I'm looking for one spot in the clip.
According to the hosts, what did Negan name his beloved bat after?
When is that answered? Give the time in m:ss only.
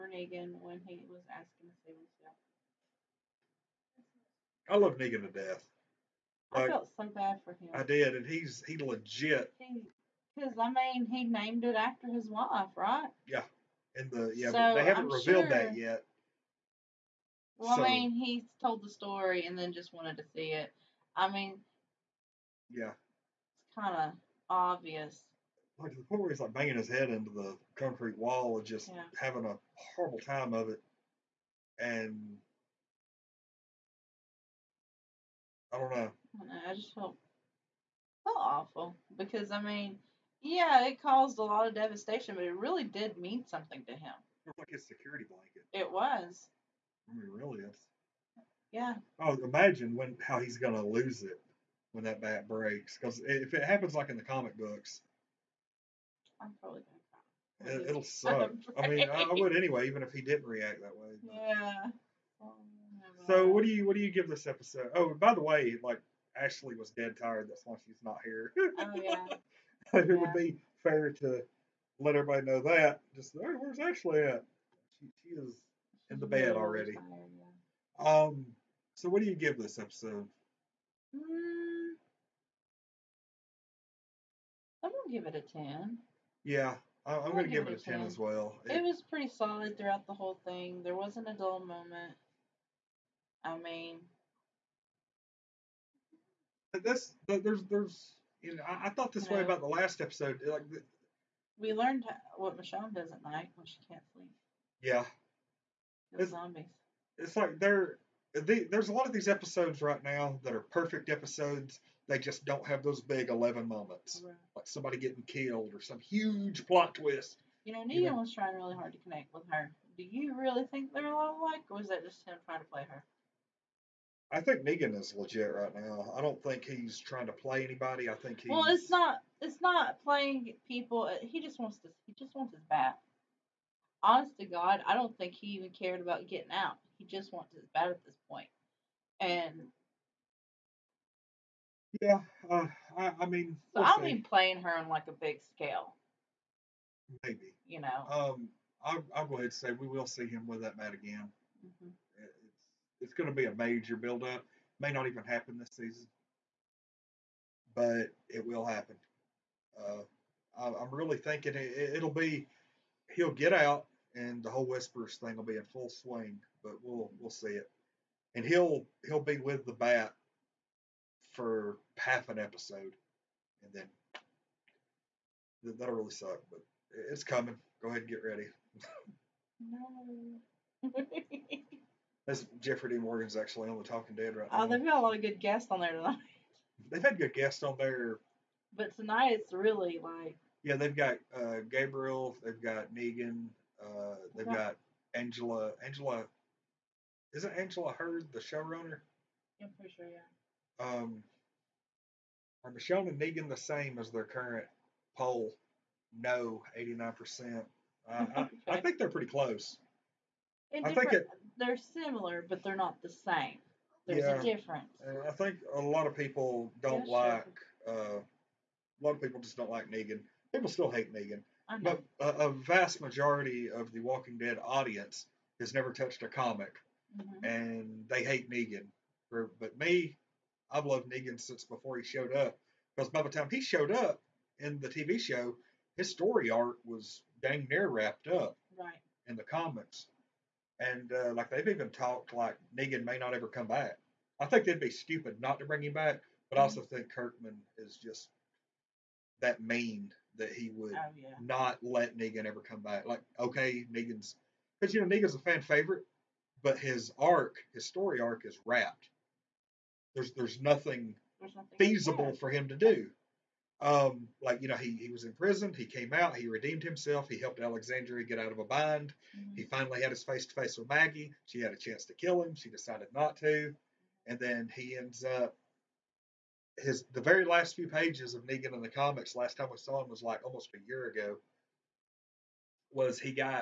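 0:11.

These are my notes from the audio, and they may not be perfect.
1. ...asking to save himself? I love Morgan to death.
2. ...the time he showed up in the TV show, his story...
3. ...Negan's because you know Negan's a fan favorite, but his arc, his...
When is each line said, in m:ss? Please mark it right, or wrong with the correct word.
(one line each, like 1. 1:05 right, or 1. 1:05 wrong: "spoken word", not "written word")
1. 0:01 wrong: "Negan", not "Morgan"
2. 3:53 right
3. 4:13 right.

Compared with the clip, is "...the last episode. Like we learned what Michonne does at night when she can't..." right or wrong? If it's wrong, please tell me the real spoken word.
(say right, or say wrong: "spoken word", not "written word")
right.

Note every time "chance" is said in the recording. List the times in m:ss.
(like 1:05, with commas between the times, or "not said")
4:31.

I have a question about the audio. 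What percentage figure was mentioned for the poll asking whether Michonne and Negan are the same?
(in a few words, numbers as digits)
89%.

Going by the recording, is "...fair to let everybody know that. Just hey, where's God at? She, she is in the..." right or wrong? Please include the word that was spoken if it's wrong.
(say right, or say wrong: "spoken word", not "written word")
wrong: "Ashley", not "God".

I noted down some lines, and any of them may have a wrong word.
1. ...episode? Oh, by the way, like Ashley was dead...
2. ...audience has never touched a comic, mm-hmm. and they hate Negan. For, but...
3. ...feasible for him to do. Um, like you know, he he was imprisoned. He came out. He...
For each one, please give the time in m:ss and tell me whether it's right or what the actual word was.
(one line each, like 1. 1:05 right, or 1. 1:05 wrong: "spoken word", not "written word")
1. 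1:04 right
2. 3:44 right
3. 4:21 right.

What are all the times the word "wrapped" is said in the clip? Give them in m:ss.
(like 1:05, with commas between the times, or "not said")
3:57, 4:18.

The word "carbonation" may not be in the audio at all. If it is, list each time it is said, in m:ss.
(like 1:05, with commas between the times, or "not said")
not said.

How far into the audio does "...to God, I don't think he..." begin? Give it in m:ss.
2:14.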